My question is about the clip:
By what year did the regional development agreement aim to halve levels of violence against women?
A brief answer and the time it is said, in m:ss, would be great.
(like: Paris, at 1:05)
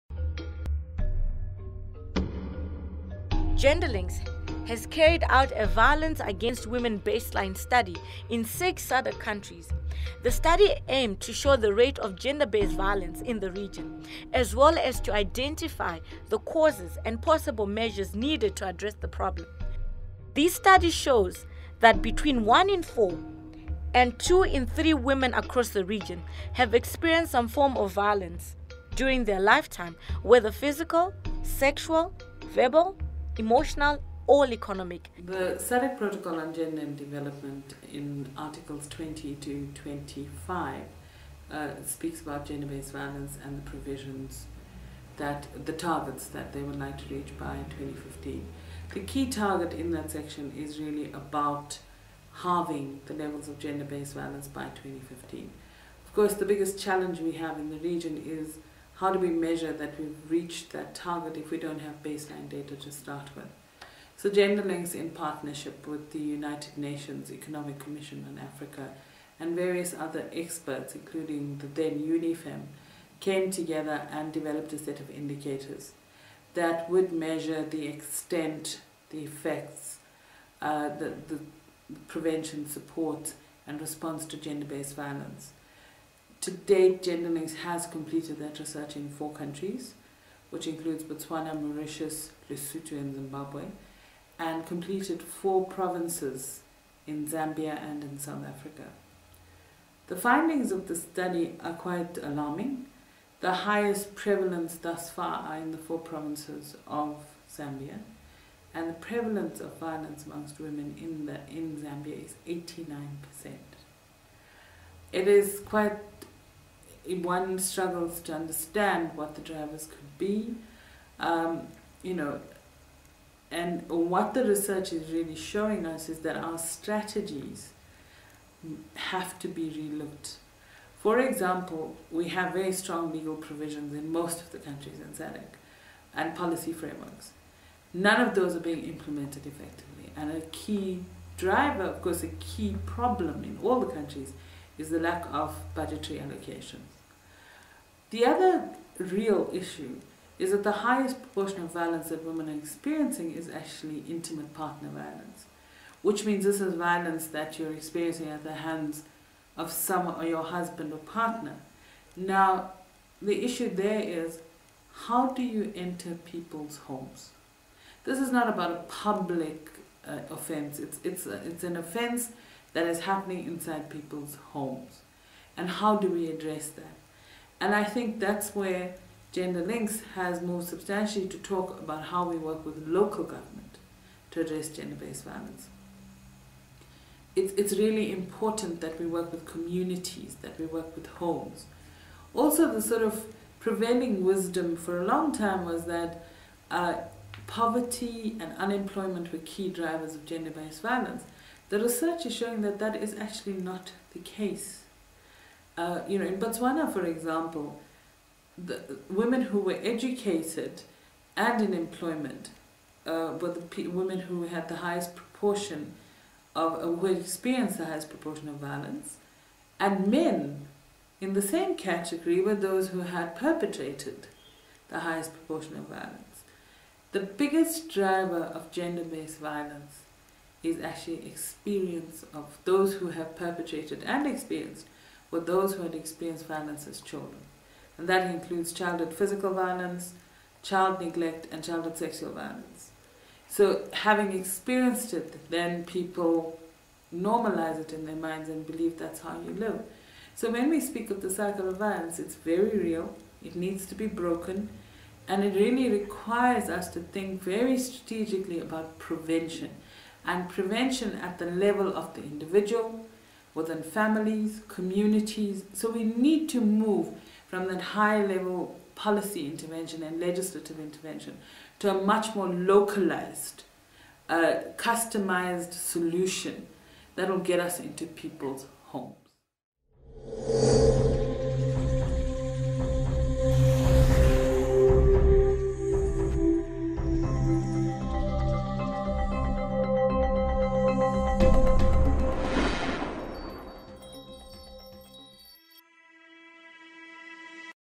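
2015, at 0:52.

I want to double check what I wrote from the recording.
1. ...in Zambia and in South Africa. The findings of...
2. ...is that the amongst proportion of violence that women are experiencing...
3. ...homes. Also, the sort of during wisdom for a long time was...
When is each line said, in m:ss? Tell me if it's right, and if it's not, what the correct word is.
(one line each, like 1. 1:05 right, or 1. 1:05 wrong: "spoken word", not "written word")
1. 1:37 right
2. 2:30 wrong: "highest", not "amongst"
3. 3:11 wrong: "prevailing", not "during".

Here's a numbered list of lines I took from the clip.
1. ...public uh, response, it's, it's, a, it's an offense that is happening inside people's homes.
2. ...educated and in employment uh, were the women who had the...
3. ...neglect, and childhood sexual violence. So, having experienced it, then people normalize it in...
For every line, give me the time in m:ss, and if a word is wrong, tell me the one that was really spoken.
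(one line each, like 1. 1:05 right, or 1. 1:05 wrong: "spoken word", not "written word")
1. 2:49 wrong: "offense", not "response"
2. 3:29 right
3. 4:01 right.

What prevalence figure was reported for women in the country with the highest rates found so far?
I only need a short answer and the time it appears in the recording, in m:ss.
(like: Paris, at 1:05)
89%, at 1:52.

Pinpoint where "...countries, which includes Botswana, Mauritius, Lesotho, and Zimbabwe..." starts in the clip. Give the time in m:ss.
1:29.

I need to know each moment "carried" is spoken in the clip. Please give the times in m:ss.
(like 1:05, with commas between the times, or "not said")
0:04.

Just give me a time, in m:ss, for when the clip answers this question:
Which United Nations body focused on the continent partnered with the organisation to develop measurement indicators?
1:06.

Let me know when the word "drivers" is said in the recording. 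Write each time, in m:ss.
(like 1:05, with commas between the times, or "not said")
1:59, 2:21, 3:19, 3:47.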